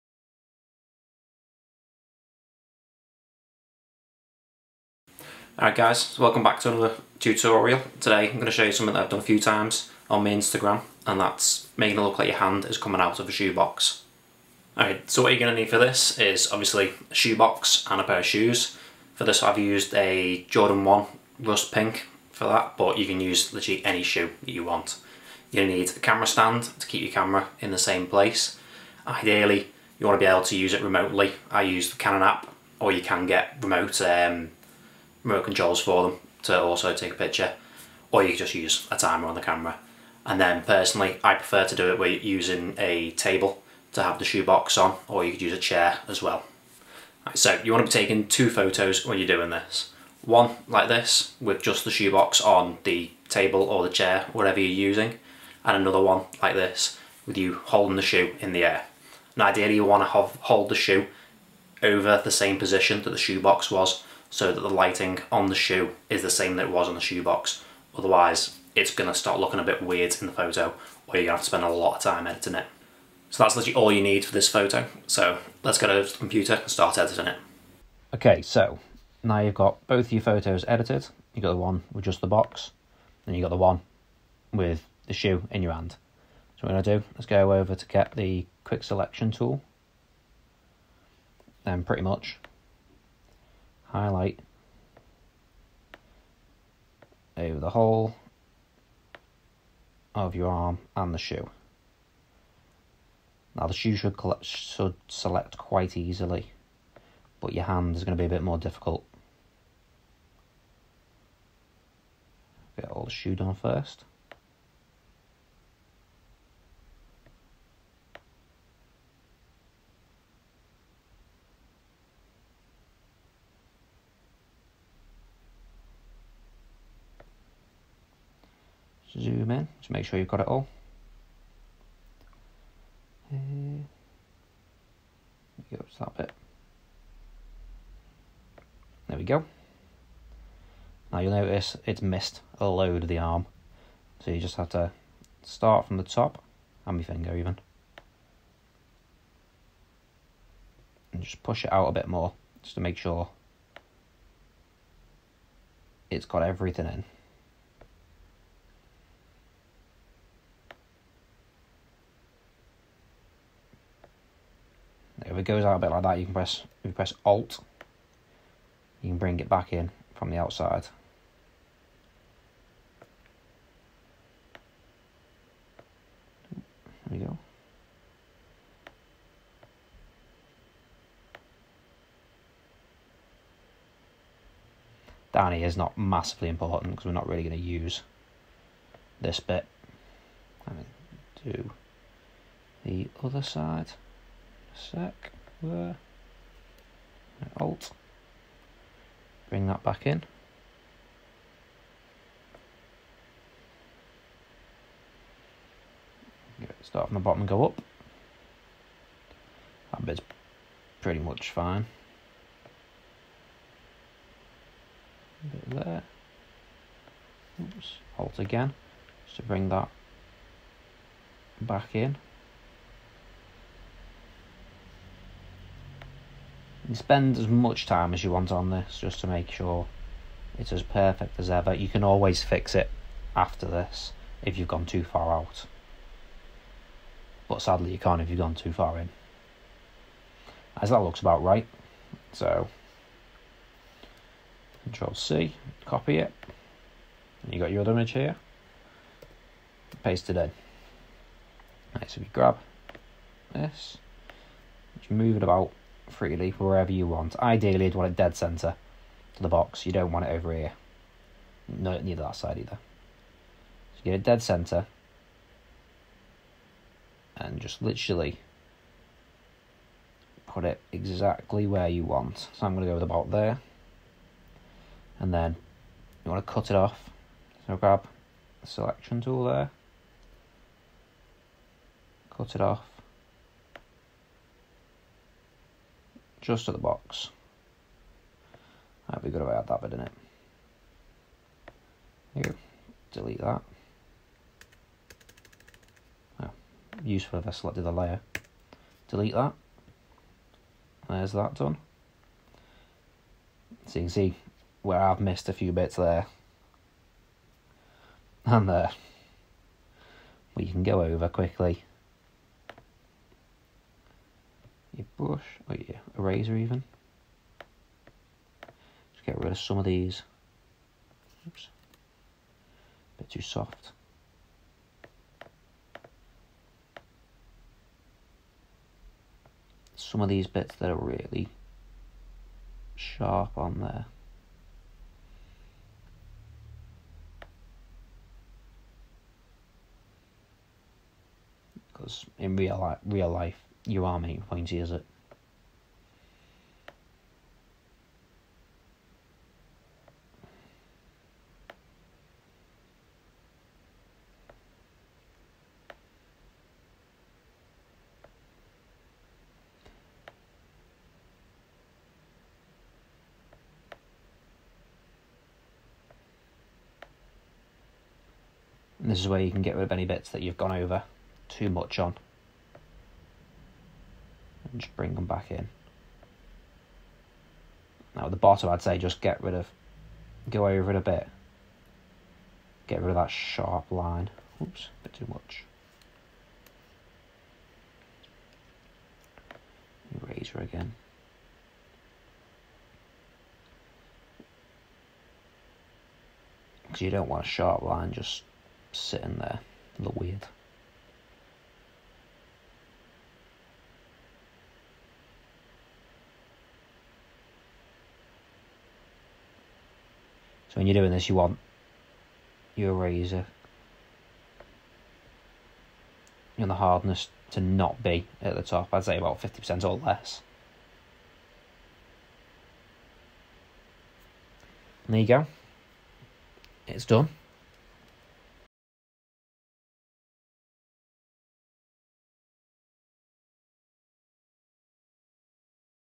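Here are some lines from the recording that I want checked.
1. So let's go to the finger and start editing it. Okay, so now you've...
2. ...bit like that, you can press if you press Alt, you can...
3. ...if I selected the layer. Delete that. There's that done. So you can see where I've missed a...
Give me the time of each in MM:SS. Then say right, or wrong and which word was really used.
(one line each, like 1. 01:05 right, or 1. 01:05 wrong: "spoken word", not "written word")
1. 01:15 wrong: "computer", not "finger"
2. 02:45 right
3. 04:57 right.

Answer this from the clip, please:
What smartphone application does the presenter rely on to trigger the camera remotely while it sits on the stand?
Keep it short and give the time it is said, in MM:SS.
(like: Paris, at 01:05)
Canon app, at 00:31.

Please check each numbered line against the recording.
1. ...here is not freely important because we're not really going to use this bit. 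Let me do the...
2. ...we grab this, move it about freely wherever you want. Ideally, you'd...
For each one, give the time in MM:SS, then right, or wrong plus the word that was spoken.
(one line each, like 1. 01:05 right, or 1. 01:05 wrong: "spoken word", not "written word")
1. 03:05 wrong: "massively", not "freely"
2. 04:12 right.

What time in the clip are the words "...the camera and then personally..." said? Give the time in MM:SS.
00:39.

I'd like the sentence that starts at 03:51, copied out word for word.
You can always fix it after this if you've gone too far out.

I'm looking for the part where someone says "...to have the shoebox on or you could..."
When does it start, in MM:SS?
00:43.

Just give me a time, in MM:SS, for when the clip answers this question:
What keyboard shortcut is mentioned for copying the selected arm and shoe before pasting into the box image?
04:04.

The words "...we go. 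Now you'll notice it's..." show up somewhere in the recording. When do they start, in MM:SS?
02:19.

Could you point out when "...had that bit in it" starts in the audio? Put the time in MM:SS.
04:49.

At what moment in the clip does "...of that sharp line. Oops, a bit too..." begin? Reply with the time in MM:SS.
06:23.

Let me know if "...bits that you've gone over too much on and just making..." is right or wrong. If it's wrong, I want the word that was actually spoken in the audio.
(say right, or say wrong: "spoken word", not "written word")
wrong: "bring", not "making".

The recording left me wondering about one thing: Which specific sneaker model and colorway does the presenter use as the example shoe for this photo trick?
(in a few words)
Jordan 1 rust pink.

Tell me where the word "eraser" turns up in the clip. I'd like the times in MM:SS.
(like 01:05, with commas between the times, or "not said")
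05:16, 06:30, 06:52.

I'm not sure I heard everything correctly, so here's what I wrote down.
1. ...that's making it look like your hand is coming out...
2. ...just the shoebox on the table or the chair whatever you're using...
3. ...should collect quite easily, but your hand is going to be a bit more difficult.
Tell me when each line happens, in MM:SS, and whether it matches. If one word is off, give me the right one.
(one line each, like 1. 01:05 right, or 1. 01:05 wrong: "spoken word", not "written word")
1. 00:11 right
2. 00:51 right
3. 01:44 wrong: "select", not "collect".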